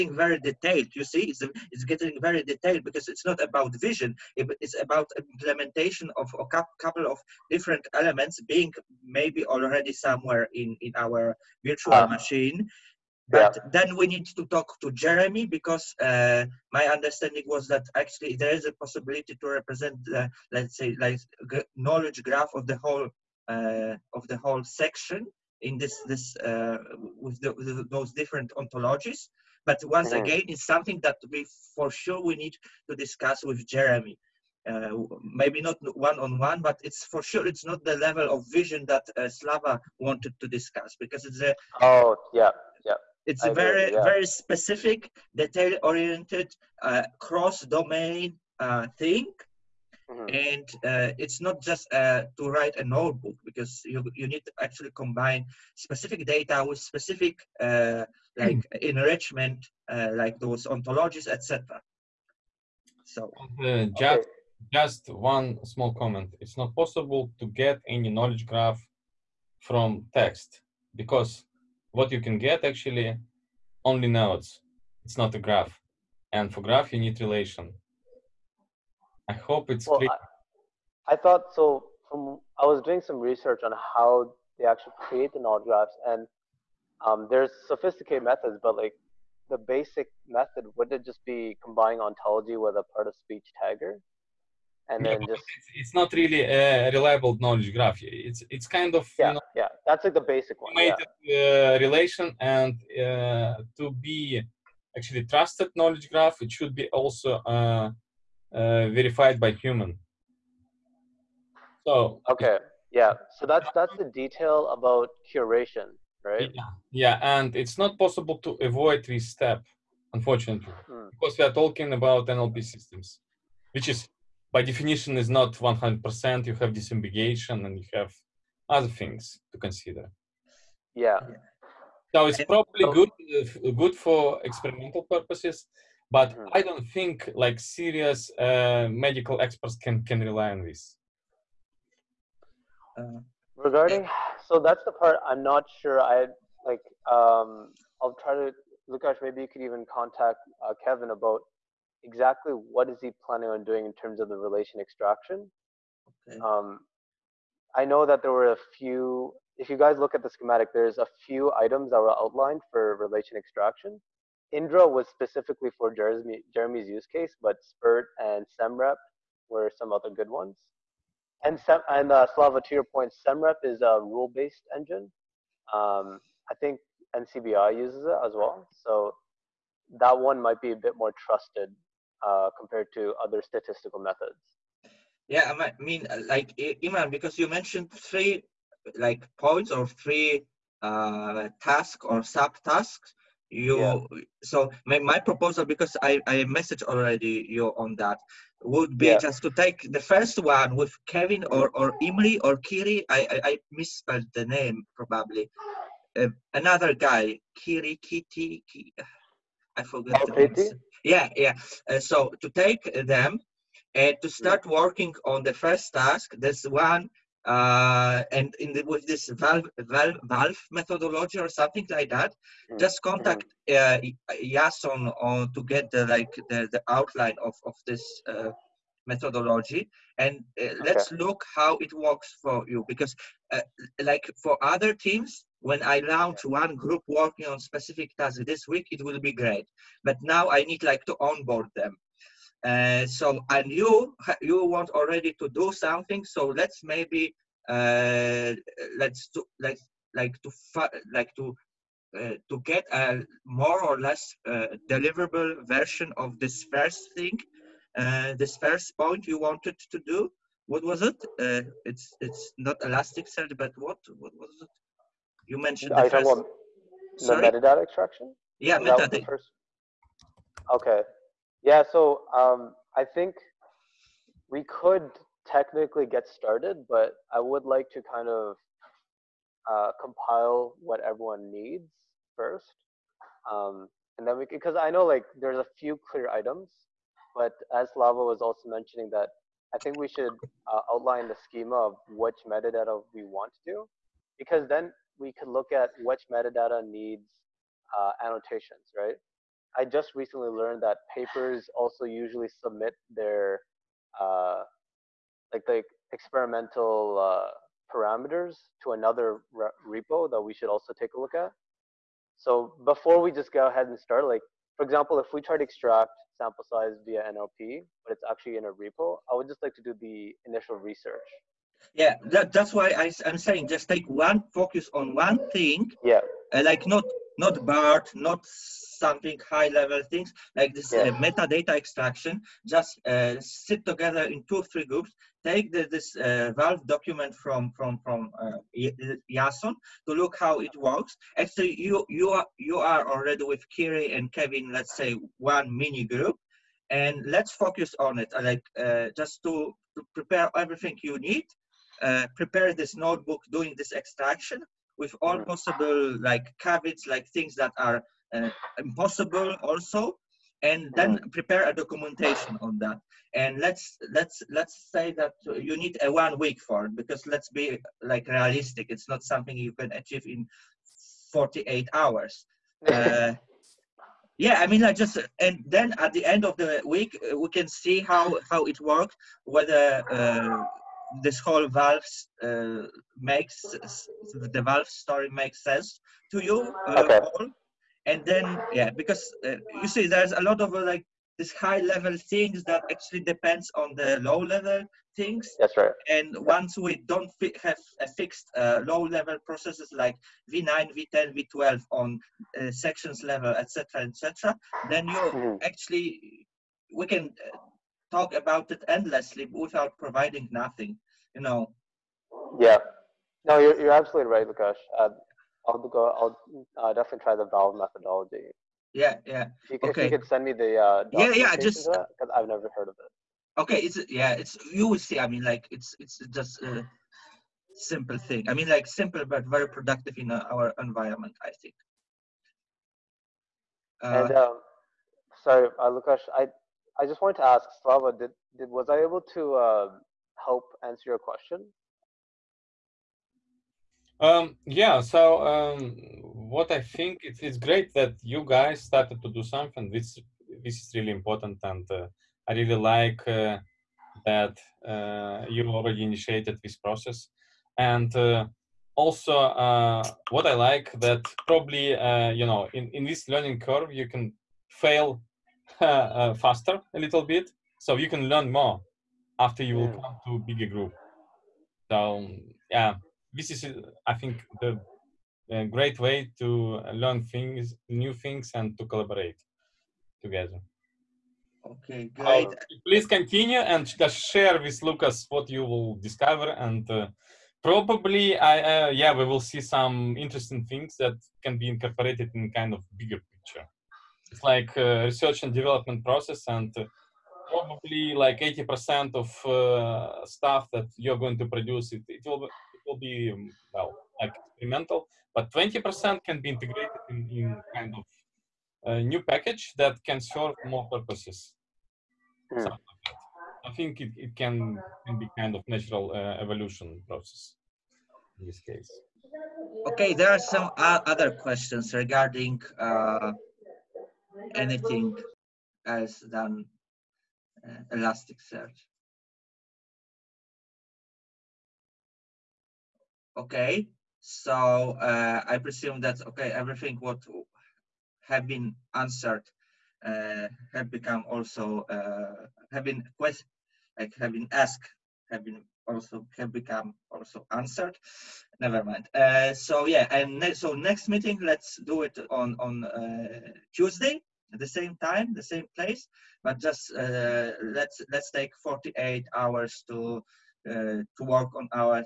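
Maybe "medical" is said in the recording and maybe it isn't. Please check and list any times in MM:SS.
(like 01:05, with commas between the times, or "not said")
02:18.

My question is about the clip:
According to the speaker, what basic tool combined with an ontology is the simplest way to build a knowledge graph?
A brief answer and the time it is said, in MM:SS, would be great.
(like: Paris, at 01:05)
part of speech tagger, at 01:32.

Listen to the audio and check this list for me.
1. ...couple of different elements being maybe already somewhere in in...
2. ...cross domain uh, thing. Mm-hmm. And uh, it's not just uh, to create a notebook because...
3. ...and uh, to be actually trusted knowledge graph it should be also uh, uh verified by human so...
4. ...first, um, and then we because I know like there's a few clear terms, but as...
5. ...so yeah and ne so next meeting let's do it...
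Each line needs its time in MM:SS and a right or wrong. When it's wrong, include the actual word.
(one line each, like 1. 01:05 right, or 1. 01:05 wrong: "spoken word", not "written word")
1. 00:06 right
2. 00:47 wrong: "write", not "create"
3. 01:42 right
4. 04:42 wrong: "items", not "terms"
5. 09:09 right.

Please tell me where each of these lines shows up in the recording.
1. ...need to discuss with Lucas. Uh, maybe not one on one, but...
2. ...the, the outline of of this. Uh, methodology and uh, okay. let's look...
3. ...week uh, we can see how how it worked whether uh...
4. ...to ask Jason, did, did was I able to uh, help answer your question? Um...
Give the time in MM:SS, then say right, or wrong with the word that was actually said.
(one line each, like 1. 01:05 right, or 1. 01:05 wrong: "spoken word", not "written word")
1. 00:32 wrong: "Jeremy", not "Lucas"
2. 03:46 right
3. 06:16 right
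4. 07:17 wrong: "Slava", not "Jason".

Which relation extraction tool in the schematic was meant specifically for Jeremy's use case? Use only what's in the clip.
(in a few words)
Indra.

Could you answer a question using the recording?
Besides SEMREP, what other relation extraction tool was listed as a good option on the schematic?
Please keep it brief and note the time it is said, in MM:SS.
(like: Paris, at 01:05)
SpERT, at 02:47.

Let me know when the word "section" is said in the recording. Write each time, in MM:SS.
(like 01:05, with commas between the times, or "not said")
00:24, 06:42.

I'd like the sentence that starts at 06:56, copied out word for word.
I'll uh, definitely try the valve methodology.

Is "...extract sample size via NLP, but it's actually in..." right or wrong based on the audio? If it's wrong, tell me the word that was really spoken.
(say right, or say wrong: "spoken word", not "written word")
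right.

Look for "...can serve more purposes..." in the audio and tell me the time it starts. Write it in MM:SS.
08:30.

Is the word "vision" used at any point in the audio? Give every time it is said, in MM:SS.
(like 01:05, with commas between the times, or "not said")
00:03, 00:38.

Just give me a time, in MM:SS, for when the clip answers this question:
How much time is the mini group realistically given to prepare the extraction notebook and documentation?
06:06.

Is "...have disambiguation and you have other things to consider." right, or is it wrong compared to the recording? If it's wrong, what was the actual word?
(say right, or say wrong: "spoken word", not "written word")
right.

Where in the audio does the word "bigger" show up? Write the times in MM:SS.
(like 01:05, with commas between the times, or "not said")
07:50, 08:12.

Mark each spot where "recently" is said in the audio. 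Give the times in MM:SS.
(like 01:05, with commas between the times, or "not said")
05:00.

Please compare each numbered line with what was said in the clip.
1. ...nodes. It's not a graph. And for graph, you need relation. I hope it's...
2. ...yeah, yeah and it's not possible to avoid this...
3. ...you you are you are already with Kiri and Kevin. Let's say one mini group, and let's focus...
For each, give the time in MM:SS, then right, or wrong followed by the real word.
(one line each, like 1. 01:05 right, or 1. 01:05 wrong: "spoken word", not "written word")
1. 01:14 right
2. 01:56 right
3. 05:41 right.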